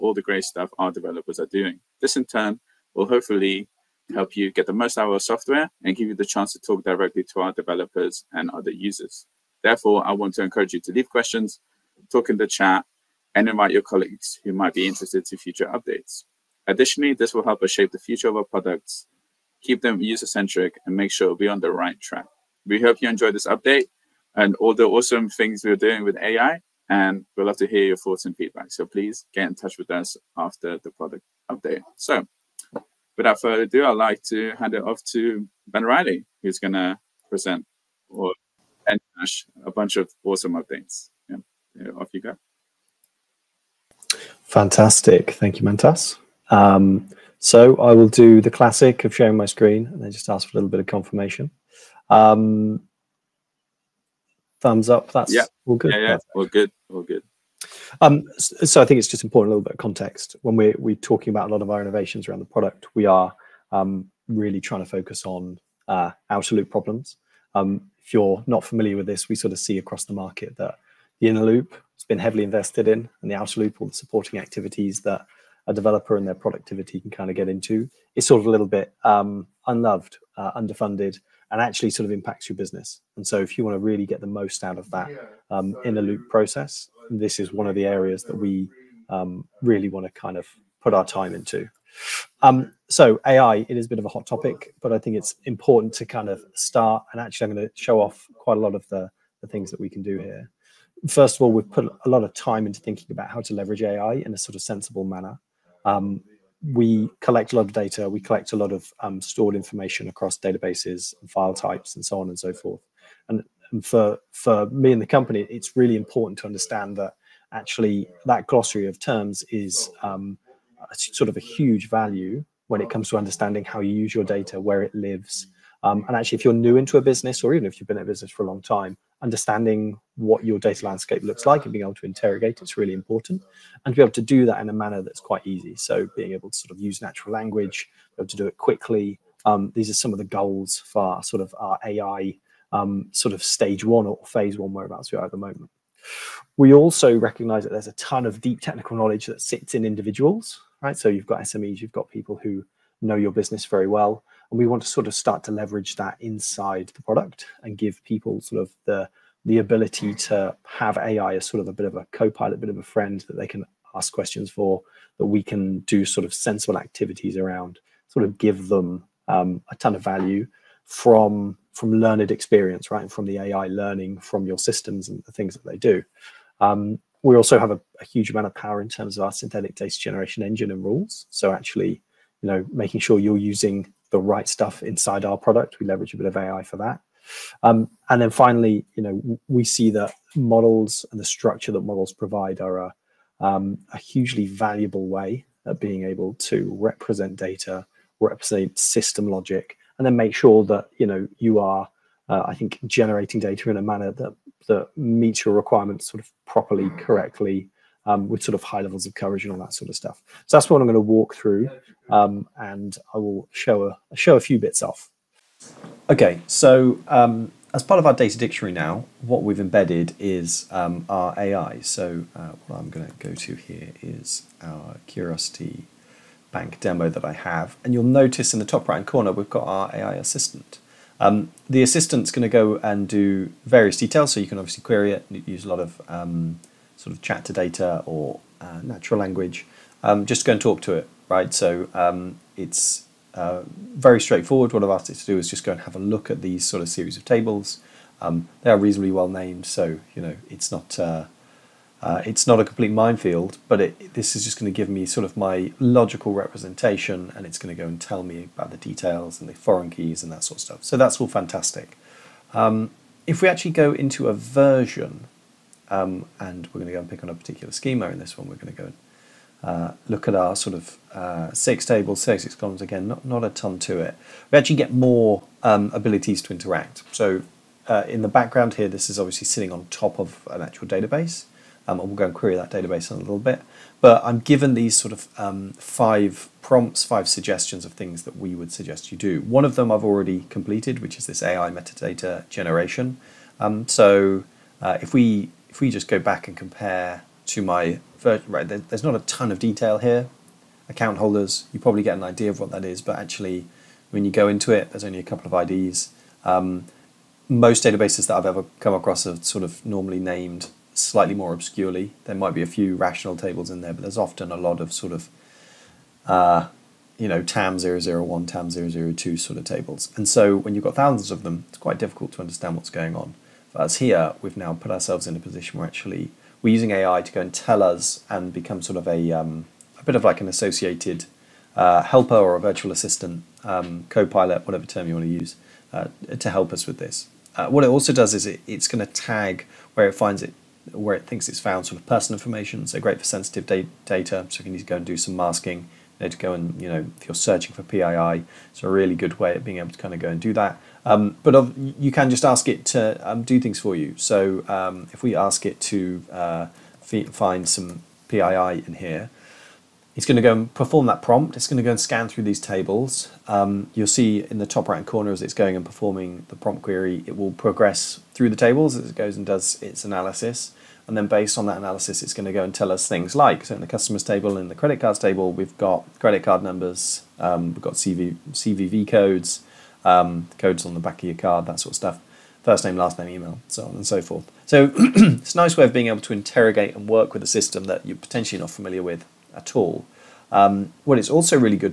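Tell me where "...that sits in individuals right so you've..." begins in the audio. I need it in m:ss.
2:29.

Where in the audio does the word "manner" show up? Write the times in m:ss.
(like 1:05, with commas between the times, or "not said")
1:45, 2:14, 3:23.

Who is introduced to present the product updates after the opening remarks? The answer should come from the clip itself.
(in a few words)
Ben Riley.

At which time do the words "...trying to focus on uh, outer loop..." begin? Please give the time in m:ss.
1:04.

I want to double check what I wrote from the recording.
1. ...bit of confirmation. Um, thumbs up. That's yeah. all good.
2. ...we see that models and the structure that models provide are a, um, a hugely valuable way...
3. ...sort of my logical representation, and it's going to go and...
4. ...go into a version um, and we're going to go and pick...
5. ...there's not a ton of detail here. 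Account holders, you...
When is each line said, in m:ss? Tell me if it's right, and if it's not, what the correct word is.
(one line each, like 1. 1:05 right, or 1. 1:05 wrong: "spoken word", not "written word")
1. 0:50 right
2. 3:09 right
3. 4:15 right
4. 4:23 right
5. 4:58 right.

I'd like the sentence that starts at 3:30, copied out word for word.
So that's what I'm going to walk through, um, and I will show a show a few bits off.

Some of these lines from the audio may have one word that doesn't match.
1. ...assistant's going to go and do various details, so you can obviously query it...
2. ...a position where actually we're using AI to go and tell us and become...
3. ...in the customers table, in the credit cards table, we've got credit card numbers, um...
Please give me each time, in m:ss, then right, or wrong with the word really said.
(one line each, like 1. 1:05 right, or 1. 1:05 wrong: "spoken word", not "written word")
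1. 3:51 right
2. 5:25 right
3. 6:13 right.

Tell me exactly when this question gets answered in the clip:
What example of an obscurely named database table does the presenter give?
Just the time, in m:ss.
5:17.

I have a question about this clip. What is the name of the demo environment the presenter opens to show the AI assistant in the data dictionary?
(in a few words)
Curiosity Bank.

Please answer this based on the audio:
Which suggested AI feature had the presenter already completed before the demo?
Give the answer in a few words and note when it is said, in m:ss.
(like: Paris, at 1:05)
AI metadata generation, at 4:51.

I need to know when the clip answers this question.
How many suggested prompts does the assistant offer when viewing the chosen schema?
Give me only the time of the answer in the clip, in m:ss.
4:45.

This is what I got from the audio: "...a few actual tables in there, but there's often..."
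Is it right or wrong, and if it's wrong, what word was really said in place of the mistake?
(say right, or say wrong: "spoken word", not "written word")
wrong: "rational", not "actual".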